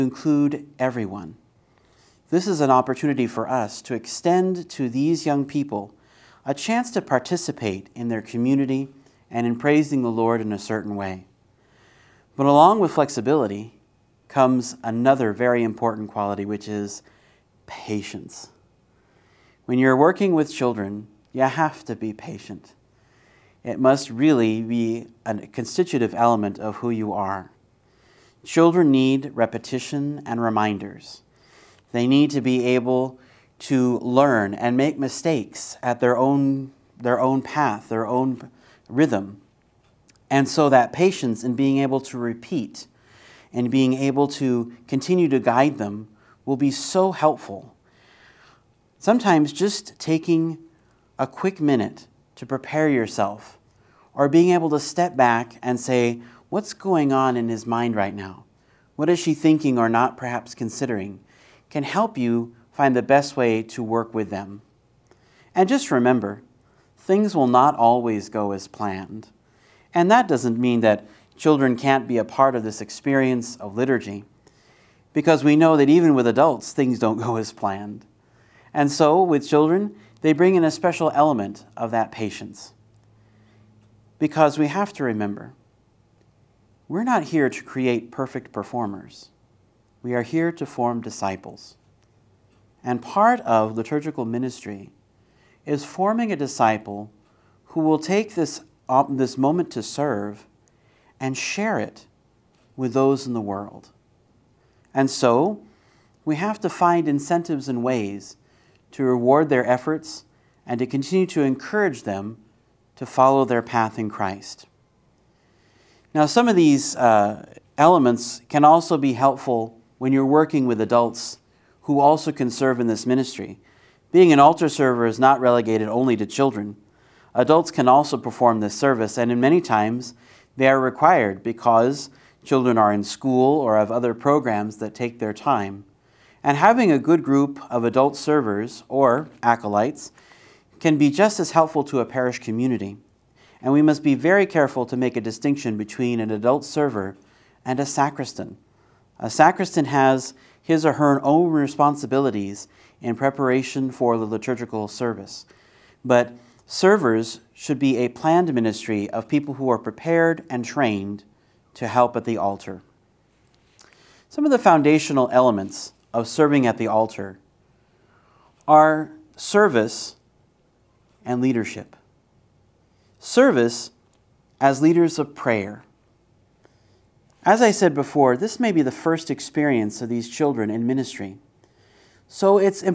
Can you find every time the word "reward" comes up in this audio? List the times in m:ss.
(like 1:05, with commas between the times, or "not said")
1:49.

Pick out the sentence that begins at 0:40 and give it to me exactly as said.
And so that patience in being able to repeat and being able to continue to guide them will be so helpful.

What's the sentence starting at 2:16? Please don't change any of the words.
And having a good group of adult servers or acolytes can be just as helpful to a parish community.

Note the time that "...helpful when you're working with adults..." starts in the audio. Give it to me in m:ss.
1:59.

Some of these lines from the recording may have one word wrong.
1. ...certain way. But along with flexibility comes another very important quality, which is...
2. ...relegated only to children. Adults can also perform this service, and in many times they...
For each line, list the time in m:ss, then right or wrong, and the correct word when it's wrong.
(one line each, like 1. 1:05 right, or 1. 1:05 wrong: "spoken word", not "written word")
1. 0:10 right
2. 2:05 right.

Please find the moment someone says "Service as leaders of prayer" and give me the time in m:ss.
2:53.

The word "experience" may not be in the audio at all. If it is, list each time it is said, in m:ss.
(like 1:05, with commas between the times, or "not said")
1:12, 2:59.